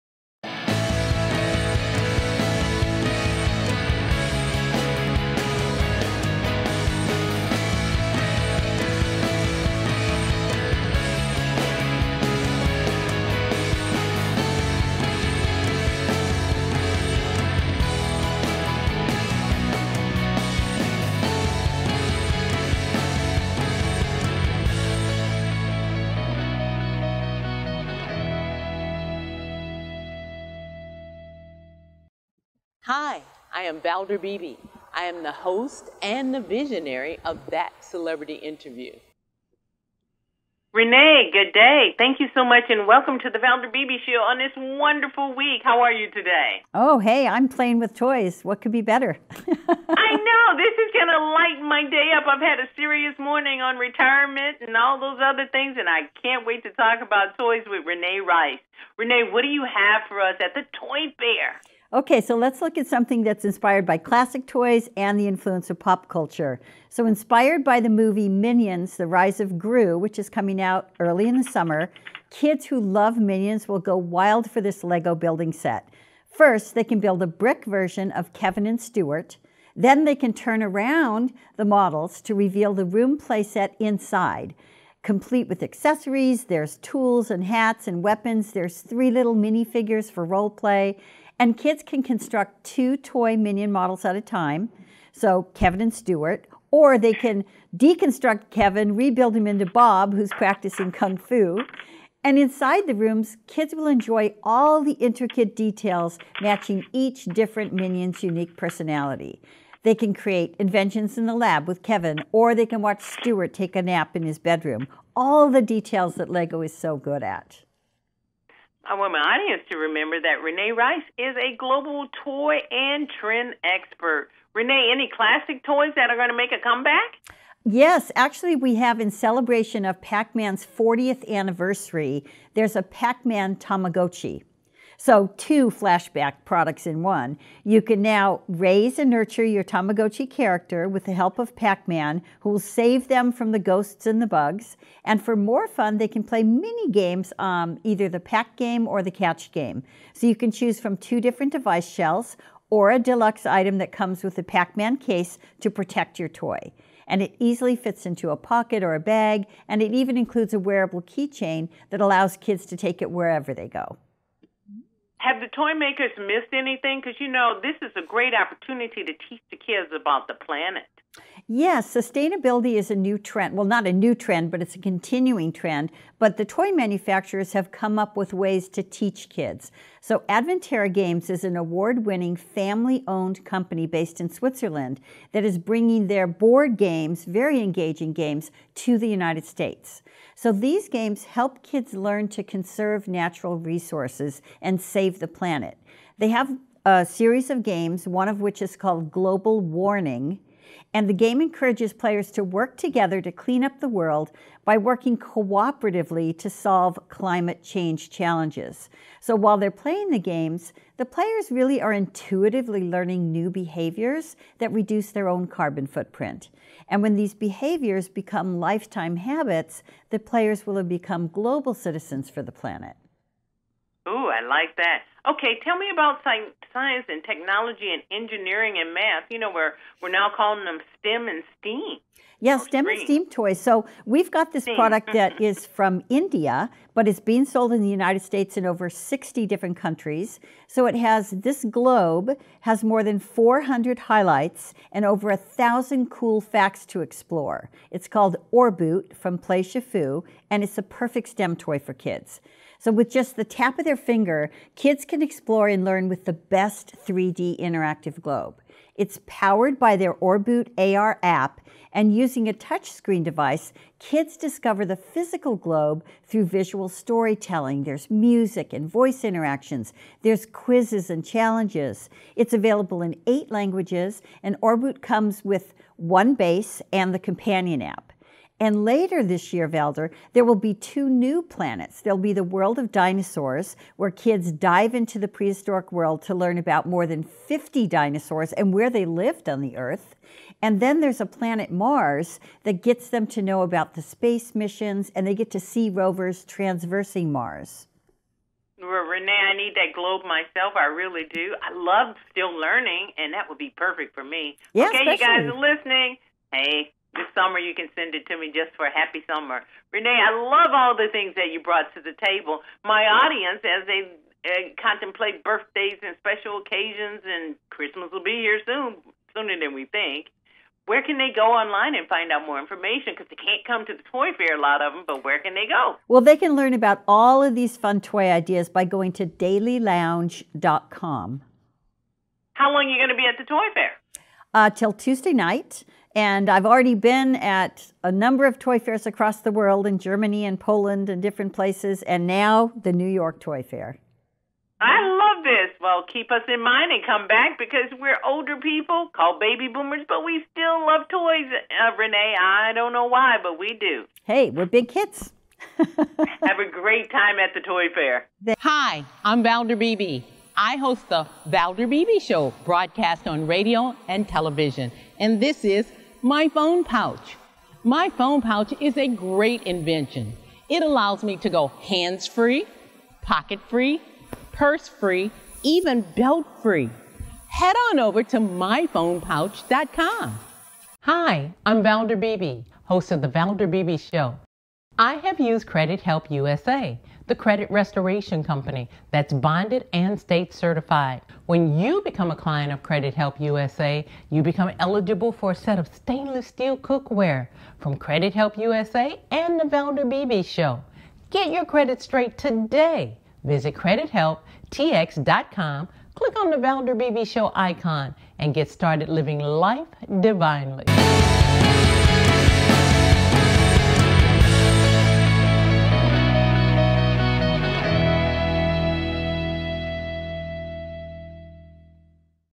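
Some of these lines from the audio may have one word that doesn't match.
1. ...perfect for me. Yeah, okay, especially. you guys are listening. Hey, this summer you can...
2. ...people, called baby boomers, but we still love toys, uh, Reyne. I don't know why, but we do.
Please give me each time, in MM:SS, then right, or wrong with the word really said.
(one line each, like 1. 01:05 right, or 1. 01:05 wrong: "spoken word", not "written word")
1. 05:03 right
2. 05:48 right.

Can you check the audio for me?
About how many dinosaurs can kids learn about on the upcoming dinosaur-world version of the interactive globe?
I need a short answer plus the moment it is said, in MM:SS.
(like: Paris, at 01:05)
50, at 04:47.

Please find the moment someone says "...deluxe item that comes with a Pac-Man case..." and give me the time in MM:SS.
02:32.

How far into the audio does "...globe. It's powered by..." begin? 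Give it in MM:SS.
04:18.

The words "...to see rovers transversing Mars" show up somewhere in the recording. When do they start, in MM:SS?
04:55.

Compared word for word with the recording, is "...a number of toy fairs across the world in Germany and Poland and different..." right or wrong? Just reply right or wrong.
right.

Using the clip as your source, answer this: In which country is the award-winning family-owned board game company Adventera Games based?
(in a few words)
Switzerland.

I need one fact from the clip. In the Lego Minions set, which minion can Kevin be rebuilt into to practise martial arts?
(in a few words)
Bob.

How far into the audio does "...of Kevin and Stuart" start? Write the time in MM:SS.
01:18.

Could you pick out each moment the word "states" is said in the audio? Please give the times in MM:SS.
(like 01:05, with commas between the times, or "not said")
03:09, 03:58, 06:30.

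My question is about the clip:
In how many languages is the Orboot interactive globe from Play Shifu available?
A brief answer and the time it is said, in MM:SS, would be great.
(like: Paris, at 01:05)
8, at 04:33.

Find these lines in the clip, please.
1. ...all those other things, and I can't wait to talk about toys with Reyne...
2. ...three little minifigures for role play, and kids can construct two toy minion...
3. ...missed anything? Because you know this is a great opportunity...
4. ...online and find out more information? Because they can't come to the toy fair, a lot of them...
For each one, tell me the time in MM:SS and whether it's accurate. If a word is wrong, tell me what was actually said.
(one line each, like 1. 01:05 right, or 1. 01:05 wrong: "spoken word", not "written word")
1. 00:54 right
2. 01:28 right
3. 02:46 right
4. 05:21 right.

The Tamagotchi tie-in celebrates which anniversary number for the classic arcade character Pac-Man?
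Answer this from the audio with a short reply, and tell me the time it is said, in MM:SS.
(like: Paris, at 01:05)
40th, at 02:10.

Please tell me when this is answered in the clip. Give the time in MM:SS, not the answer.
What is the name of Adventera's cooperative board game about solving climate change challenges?
03:19.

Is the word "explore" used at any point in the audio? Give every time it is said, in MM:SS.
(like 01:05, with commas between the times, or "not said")
04:07, 04:15.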